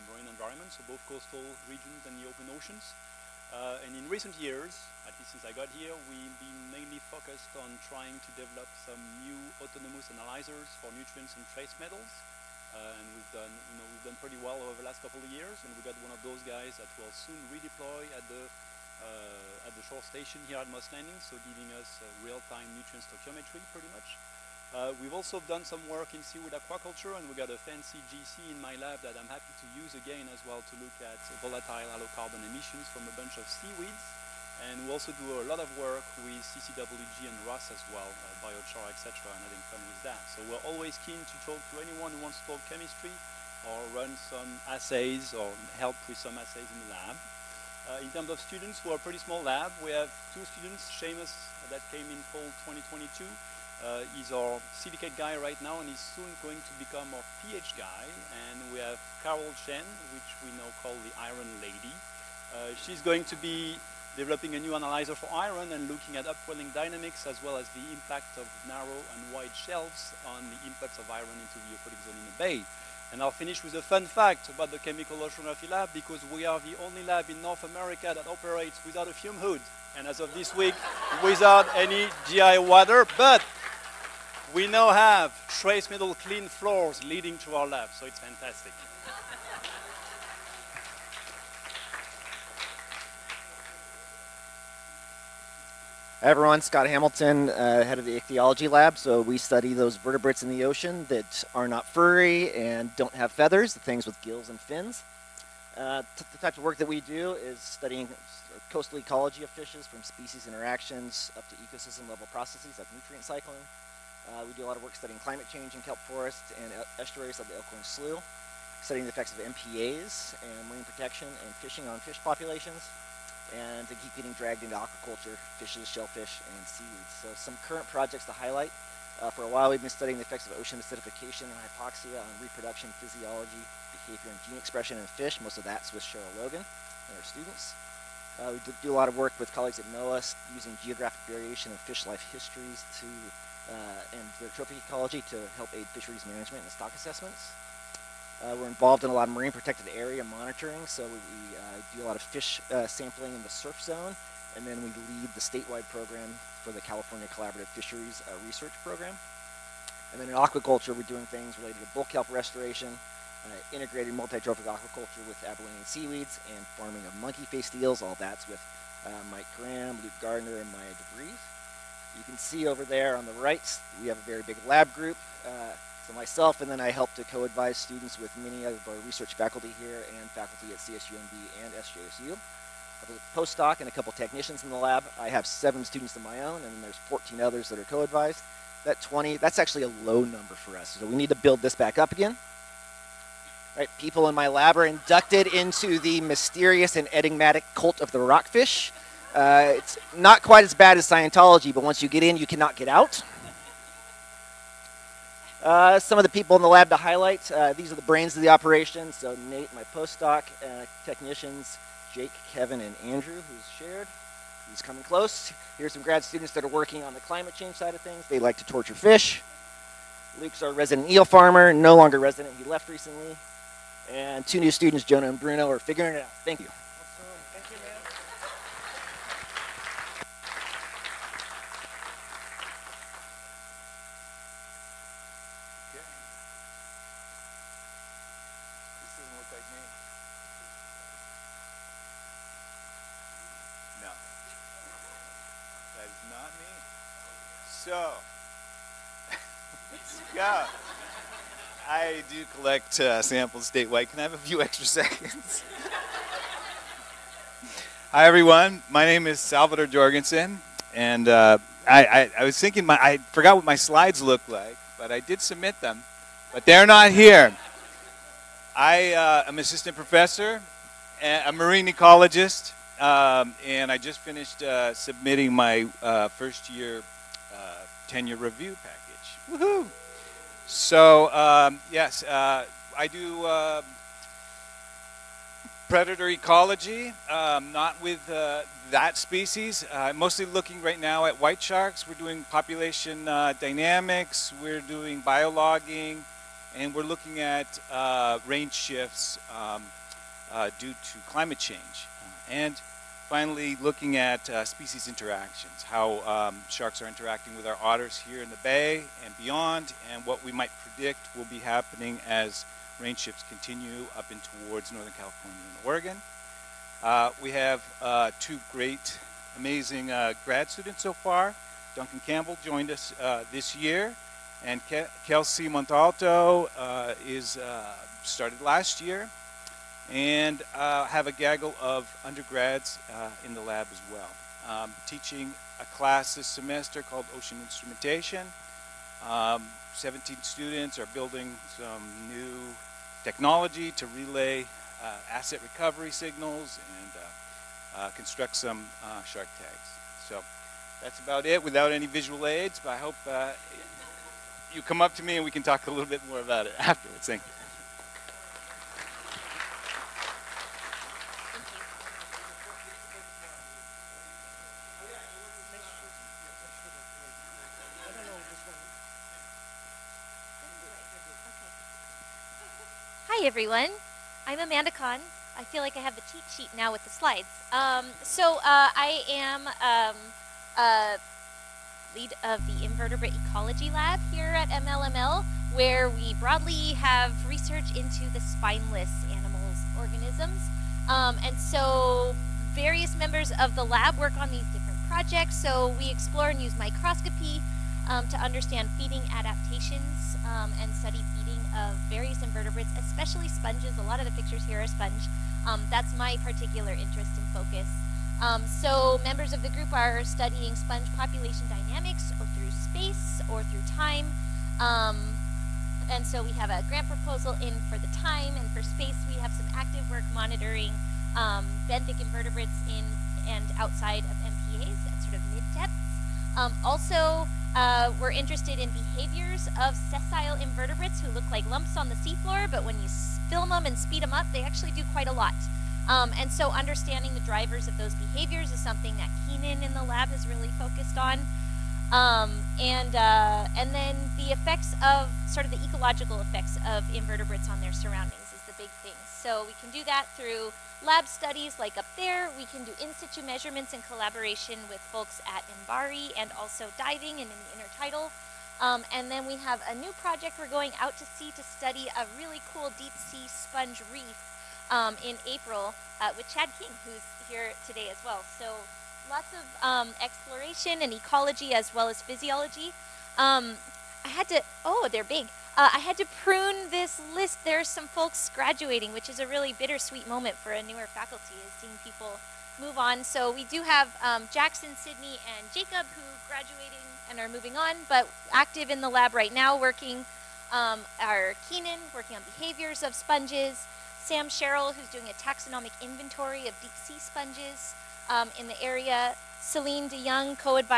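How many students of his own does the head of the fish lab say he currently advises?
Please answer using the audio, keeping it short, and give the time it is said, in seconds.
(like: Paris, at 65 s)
7, at 185 s.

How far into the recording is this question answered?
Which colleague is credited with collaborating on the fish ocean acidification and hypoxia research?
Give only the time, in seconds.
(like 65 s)
136 s.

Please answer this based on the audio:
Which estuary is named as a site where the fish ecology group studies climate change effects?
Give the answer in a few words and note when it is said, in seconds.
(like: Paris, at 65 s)
Elkhorn Slough, at 117 s.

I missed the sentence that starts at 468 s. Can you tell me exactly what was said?
So lots of um, exploration and ecology as well as physiology.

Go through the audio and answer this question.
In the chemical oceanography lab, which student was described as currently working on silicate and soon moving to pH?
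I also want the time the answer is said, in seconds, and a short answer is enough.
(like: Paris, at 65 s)
Seamus, at 50 s.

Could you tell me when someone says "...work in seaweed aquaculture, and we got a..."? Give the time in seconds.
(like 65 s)
25 s.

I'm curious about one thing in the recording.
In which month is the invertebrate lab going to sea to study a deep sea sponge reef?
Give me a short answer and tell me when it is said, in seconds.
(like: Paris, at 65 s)
April, at 465 s.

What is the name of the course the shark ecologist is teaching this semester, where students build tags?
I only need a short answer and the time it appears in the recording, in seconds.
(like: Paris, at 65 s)
Ocean Instrumentation, at 337 s.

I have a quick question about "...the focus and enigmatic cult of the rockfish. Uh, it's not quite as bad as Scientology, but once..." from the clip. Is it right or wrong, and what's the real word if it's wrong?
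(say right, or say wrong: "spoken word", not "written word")
wrong: "mysterious", not "focus".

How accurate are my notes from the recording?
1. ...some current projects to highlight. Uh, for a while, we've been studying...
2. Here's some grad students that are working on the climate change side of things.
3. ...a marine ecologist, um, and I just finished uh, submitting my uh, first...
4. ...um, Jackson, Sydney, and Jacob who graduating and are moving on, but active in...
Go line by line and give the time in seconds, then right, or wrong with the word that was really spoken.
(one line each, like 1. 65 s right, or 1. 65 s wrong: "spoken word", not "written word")
1. 127 s right
2. 215 s right
3. 271 s right
4. 484 s right.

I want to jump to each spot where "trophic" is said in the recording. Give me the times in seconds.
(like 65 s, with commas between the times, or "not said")
144 s, 164 s.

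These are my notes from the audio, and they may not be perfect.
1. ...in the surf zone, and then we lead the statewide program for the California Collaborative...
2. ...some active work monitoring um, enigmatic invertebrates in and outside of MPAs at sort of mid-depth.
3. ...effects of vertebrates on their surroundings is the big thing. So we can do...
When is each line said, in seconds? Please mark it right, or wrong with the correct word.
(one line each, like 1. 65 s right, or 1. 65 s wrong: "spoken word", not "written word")
1. 153 s right
2. 419 s wrong: "benthic", not "enigmatic"
3. 446 s wrong: "invertebrates", not "vertebrates".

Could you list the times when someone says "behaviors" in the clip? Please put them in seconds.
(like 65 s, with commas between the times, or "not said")
133 s, 428 s, 438 s, 492 s.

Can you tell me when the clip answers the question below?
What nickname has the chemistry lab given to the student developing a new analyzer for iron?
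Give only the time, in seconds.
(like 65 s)
61 s.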